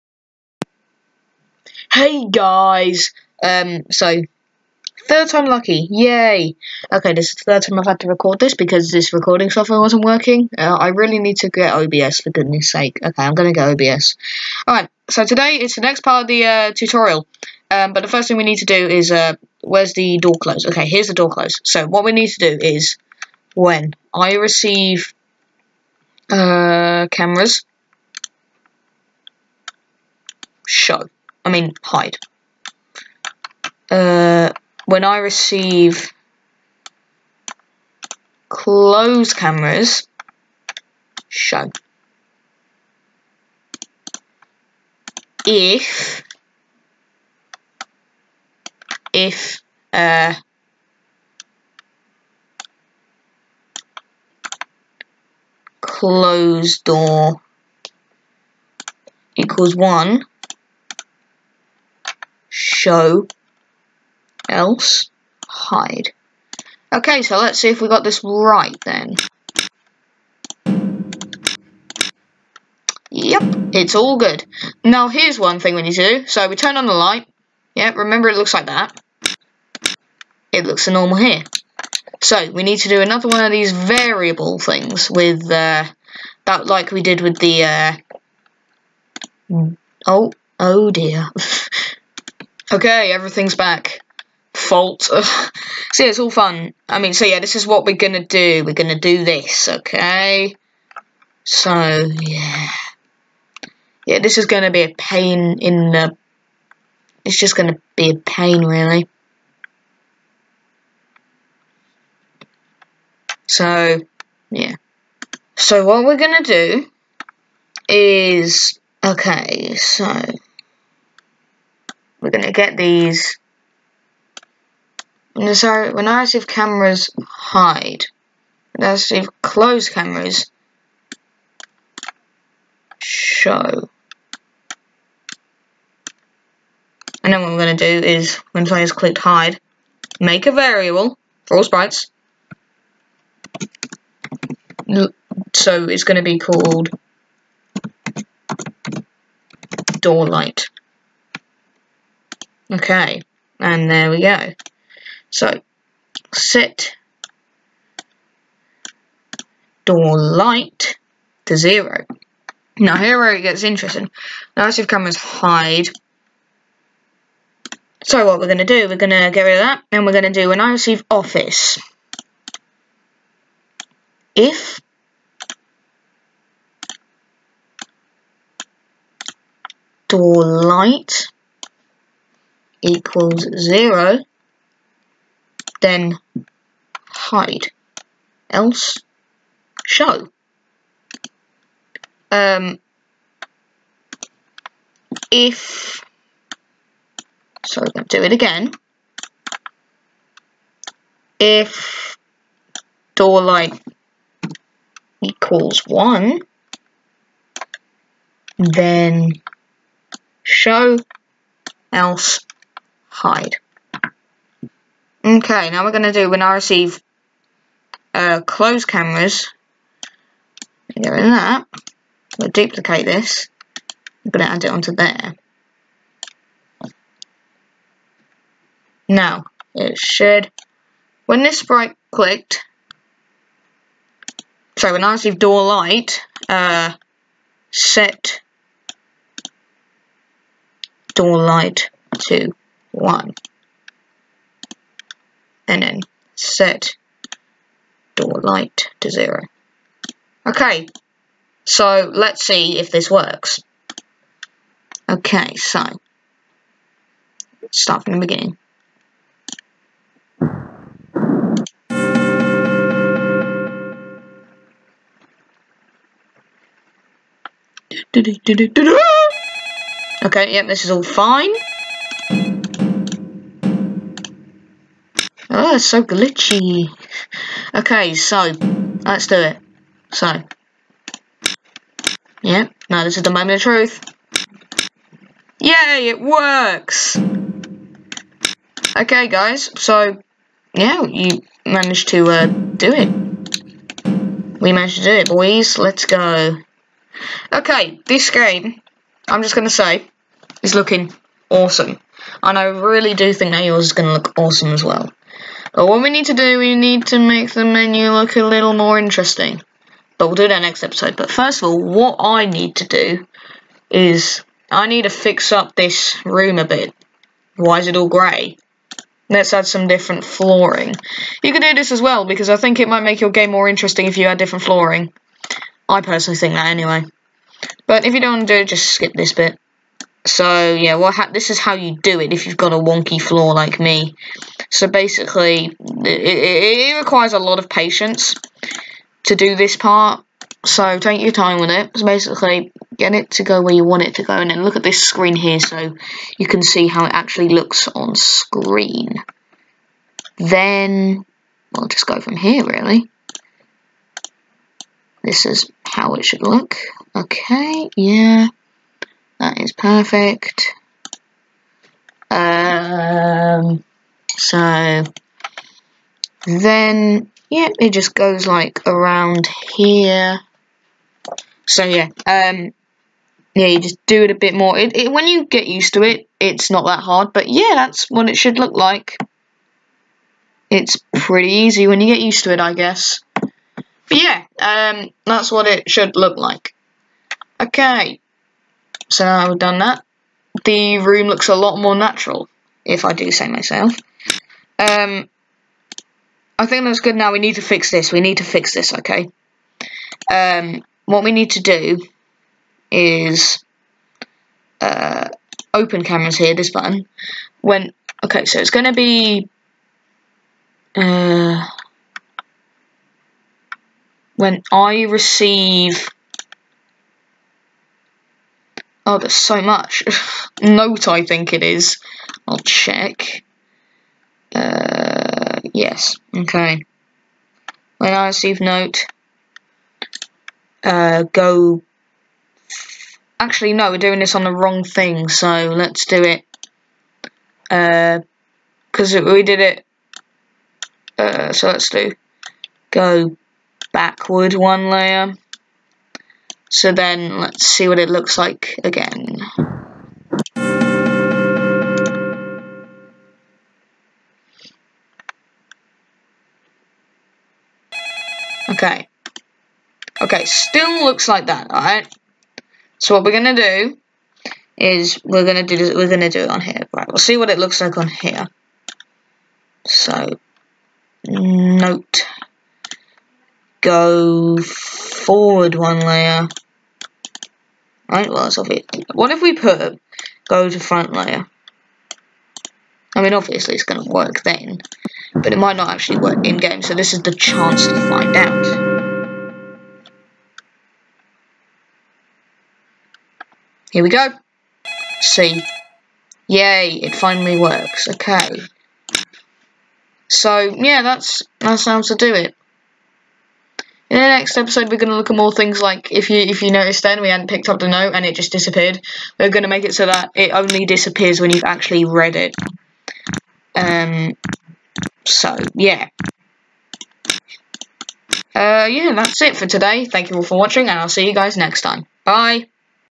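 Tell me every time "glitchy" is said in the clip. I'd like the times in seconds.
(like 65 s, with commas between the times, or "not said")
276 s.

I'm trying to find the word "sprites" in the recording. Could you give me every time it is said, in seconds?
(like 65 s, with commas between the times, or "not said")
141 s, 231 s.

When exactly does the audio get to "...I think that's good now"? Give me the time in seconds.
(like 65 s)
396 s.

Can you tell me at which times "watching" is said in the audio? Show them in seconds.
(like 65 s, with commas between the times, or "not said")
520 s.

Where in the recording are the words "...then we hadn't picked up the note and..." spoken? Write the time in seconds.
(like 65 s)
507 s.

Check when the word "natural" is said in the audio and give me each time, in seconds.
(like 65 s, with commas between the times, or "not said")
391 s.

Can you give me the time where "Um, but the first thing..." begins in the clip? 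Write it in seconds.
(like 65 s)
17 s.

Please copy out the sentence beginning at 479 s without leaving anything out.
What if we put go to front layer?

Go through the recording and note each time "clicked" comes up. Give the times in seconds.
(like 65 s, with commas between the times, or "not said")
138 s, 232 s.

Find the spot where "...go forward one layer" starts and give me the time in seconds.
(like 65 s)
473 s.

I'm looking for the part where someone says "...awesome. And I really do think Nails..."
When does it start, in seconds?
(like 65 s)
301 s.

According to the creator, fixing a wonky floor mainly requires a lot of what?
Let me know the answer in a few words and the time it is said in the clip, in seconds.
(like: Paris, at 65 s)
patience, at 337 s.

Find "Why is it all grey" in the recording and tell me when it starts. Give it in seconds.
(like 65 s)
317 s.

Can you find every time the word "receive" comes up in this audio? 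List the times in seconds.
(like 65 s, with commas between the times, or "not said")
24 s, 35 s, 170 s, 216 s, 235 s, 415 s, 428 s.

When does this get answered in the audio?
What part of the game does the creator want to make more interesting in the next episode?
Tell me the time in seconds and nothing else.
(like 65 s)
307 s.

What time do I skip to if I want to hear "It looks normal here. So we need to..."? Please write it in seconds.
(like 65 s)
80 s.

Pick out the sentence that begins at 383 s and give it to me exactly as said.
But yeah, um, that's what it should look like.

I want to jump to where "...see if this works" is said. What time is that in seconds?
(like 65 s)
252 s.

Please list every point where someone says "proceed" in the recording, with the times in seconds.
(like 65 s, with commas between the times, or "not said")
not said.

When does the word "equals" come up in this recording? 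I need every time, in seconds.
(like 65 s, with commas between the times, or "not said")
59 s, 182 s, 205 s.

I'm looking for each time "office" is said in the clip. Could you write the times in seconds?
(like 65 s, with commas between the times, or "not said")
171 s.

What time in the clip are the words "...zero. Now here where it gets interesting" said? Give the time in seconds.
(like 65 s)
161 s.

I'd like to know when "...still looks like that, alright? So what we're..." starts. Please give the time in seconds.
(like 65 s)
460 s.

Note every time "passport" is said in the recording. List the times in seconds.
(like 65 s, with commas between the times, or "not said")
not said.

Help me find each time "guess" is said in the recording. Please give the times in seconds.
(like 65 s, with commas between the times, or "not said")
382 s.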